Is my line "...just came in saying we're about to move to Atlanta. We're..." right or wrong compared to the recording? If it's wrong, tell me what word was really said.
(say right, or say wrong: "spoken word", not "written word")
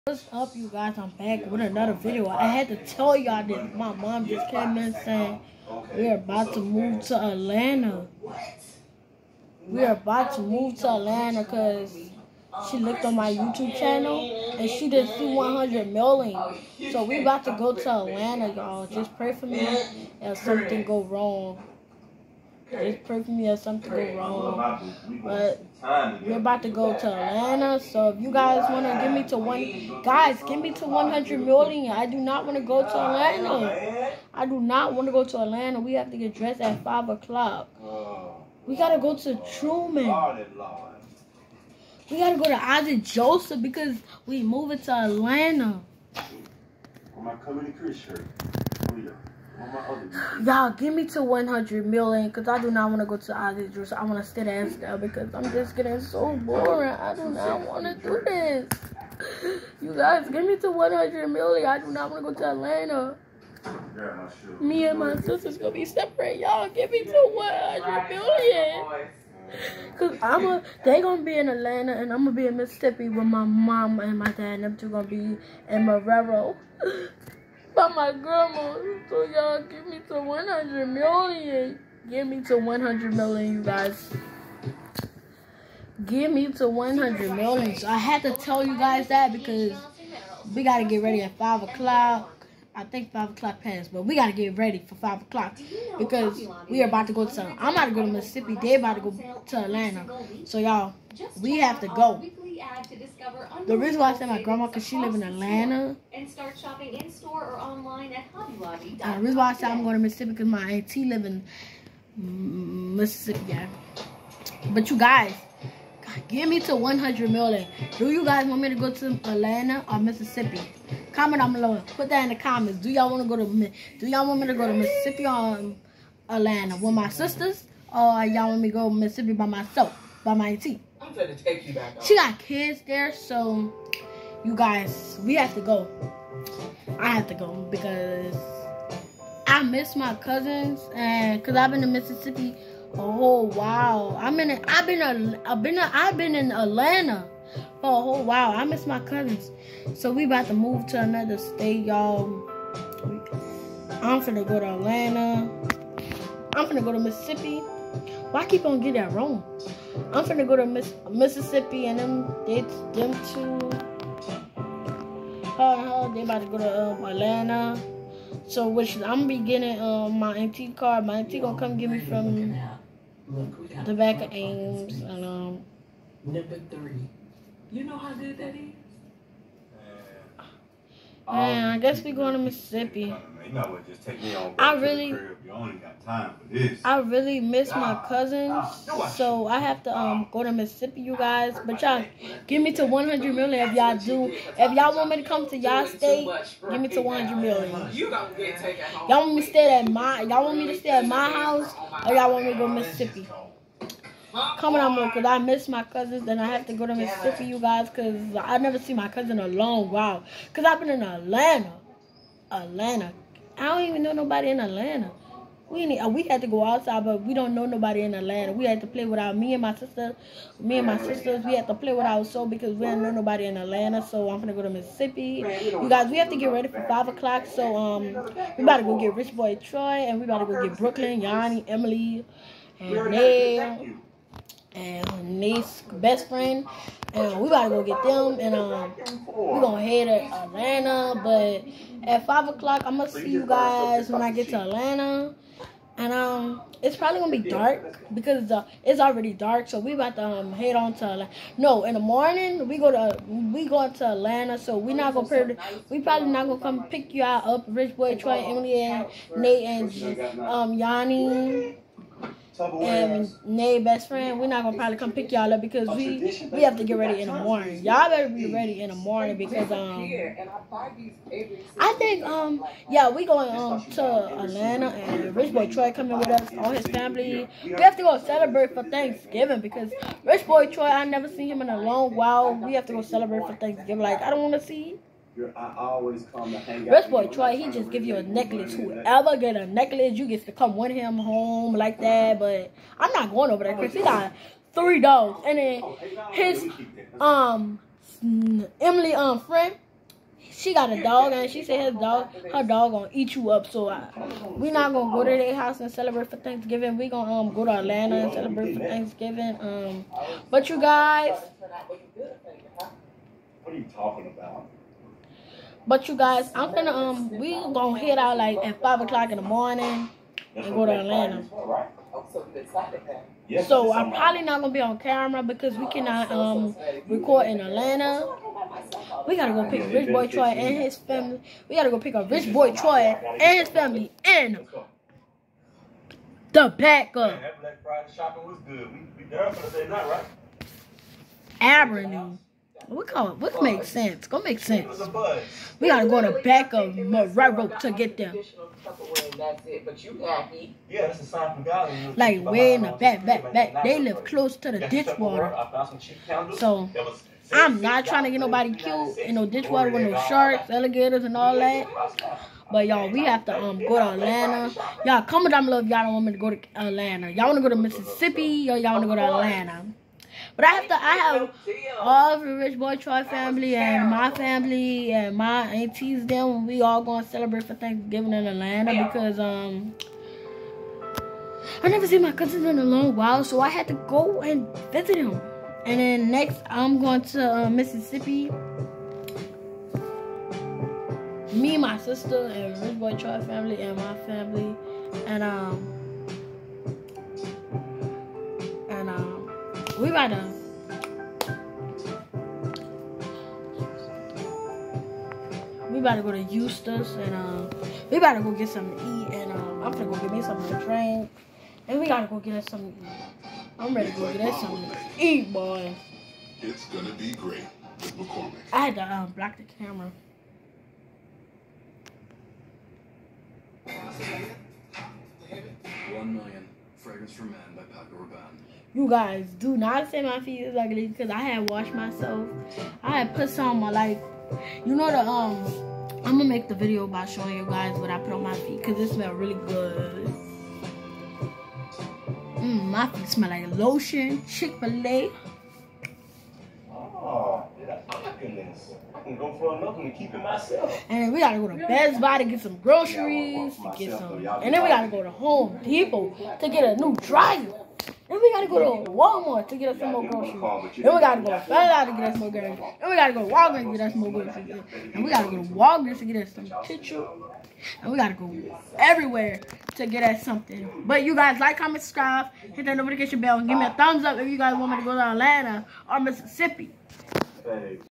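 right.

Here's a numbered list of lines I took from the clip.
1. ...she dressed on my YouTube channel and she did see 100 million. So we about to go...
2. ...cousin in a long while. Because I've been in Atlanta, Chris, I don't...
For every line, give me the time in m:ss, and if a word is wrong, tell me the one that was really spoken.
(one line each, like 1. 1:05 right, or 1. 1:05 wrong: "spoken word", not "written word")
1. 0:12 wrong: "looked", not "dressed"
2. 3:29 wrong: "Atlanta", not "Chris".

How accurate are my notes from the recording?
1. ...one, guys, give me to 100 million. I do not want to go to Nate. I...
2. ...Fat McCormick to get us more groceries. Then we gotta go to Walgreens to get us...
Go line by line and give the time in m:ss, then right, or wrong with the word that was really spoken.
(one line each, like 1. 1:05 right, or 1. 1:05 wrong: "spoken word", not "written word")
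1. 0:29 wrong: "Atlanta", not "Nate"
2. 7:41 wrong: "Out", not "McCormick".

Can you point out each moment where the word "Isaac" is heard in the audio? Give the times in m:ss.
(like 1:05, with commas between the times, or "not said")
0:42.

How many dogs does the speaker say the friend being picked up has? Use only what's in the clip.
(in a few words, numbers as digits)
3.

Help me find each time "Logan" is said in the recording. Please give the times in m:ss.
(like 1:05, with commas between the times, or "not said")
not said.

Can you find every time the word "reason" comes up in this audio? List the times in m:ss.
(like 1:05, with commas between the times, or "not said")
1:43, 1:49.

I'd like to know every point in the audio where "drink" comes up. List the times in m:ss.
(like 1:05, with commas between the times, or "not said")
6:50.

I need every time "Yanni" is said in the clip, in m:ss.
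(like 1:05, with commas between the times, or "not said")
3:51, 4:20.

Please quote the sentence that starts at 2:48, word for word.
So which I'm be getting um, my MT car.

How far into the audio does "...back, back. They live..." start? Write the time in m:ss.
5:53.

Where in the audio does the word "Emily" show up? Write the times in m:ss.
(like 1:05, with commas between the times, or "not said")
3:51, 4:18, 4:58.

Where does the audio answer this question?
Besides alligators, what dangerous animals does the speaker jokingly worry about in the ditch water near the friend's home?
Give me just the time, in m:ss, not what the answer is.
6:00.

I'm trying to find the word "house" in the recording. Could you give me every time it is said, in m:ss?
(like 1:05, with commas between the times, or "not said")
3:21, 5:05.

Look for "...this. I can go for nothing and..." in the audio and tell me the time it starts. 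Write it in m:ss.
7:28.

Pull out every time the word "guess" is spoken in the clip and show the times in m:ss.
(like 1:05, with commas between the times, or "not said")
3:01.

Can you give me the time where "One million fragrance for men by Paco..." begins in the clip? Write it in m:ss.
7:06.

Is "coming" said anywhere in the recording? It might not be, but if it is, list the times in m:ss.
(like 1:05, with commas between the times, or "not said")
0:47, 3:24, 4:35.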